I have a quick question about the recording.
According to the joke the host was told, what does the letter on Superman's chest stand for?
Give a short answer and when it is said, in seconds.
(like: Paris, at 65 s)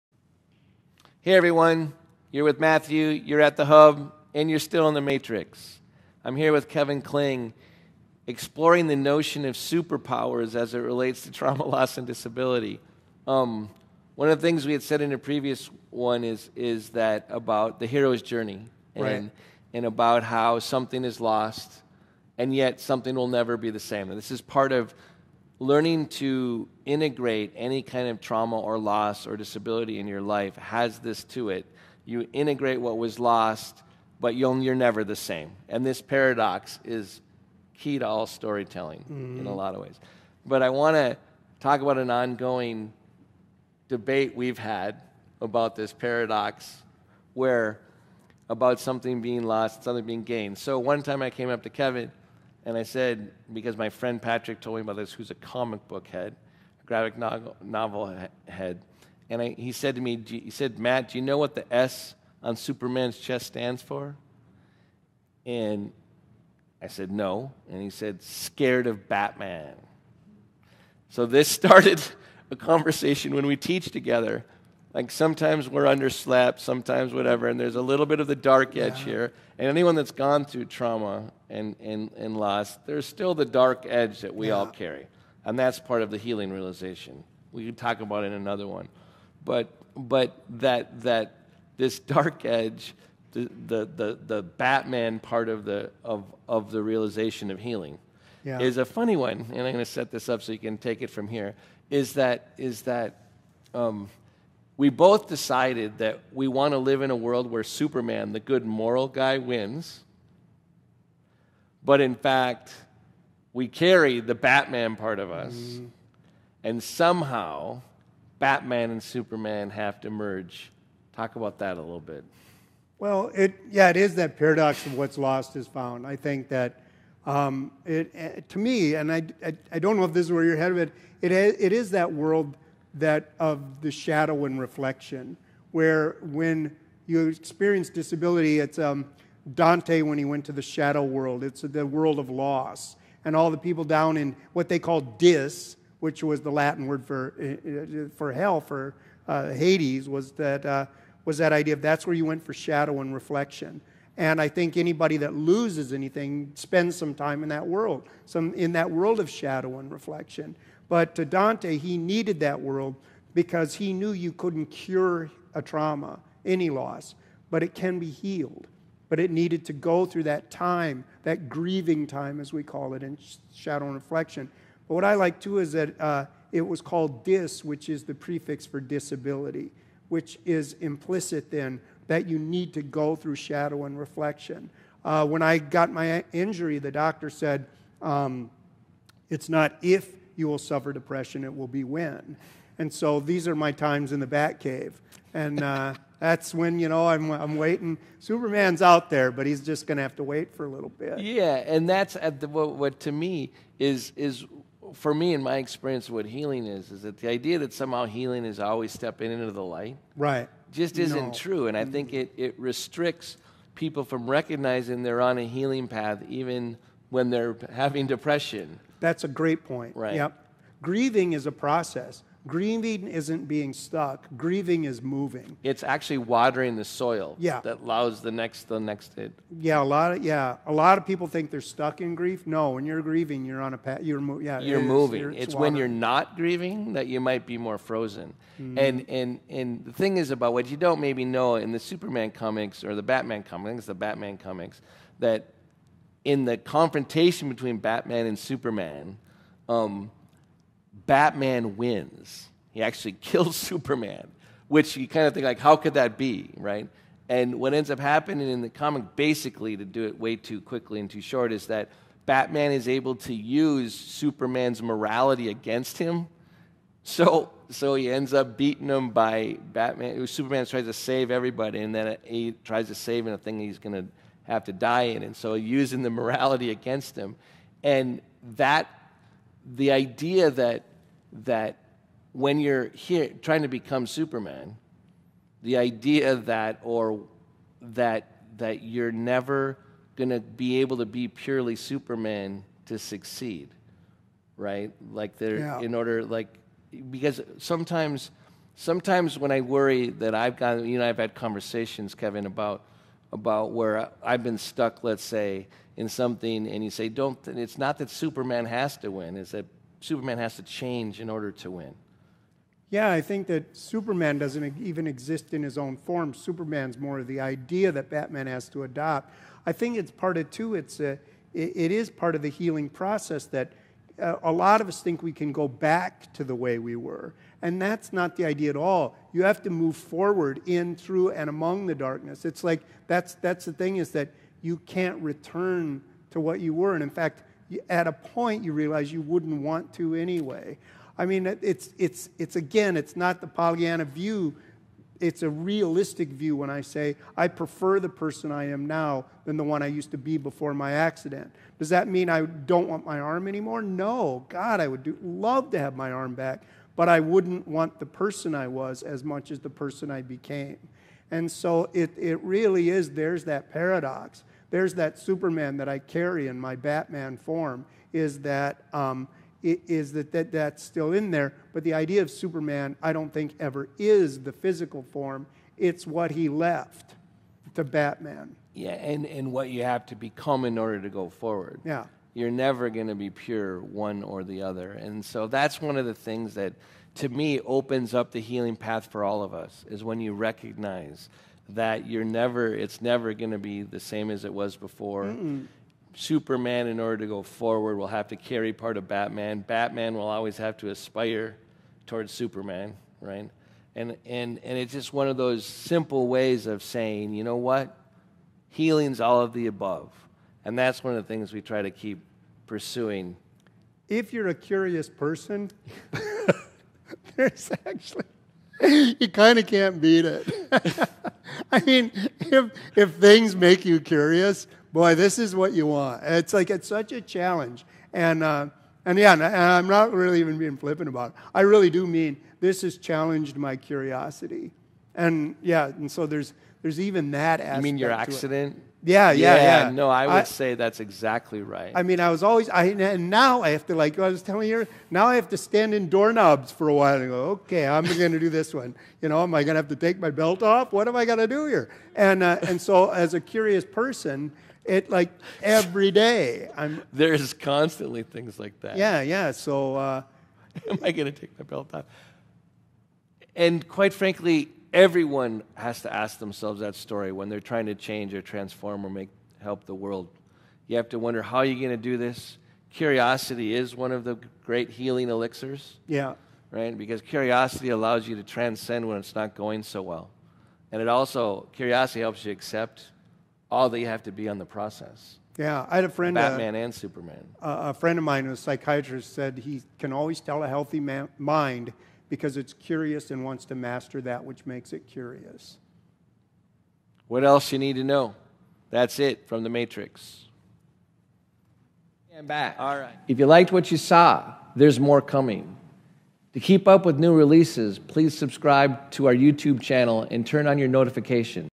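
Scared of Batman, at 68 s.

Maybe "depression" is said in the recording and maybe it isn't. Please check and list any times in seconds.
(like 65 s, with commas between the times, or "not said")
190 s, 218 s.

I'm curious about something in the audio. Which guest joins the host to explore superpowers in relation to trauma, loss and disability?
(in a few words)
Kevin Kling.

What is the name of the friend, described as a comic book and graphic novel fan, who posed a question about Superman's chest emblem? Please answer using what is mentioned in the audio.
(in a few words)
Patrick.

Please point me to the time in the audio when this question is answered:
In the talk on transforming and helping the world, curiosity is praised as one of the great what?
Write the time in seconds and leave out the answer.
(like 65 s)
474 s.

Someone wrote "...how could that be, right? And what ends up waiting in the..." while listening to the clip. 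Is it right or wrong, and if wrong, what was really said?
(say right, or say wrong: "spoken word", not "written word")
wrong: "happening", not "waiting".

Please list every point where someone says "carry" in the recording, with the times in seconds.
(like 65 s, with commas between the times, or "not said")
84 s, 113 s, 365 s, 398 s.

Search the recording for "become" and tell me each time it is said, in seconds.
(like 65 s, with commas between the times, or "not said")
283 s, 380 s.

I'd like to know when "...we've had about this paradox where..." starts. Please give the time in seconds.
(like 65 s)
44 s.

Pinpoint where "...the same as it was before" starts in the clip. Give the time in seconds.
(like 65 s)
393 s.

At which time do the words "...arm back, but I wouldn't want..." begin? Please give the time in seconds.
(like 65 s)
356 s.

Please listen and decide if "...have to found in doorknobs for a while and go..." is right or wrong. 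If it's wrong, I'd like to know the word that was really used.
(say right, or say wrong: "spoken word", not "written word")
wrong: "stand", not "found".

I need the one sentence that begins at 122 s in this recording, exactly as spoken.
Well, it, yeah, it is that paradox of what's lost is found.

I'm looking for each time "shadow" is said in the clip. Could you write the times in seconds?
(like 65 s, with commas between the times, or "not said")
133 s, 140 s, 152 s, 159 s, 173 s, 183 s.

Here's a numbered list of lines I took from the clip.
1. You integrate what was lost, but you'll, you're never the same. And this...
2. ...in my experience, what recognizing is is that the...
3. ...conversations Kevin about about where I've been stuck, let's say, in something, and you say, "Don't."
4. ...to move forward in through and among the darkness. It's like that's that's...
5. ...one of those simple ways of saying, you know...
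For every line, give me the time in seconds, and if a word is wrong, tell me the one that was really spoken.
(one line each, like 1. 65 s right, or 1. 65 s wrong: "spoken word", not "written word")
1. 32 s right
2. 205 s wrong: "healing", not "recognizing"
3. 301 s right
4. 329 s right
5. 405 s right.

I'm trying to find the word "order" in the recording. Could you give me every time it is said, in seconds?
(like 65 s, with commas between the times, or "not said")
295 s, 311 s, 380 s, 396 s.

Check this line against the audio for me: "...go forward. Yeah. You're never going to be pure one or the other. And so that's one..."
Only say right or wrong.
right.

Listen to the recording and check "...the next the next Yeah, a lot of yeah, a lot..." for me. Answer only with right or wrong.
right.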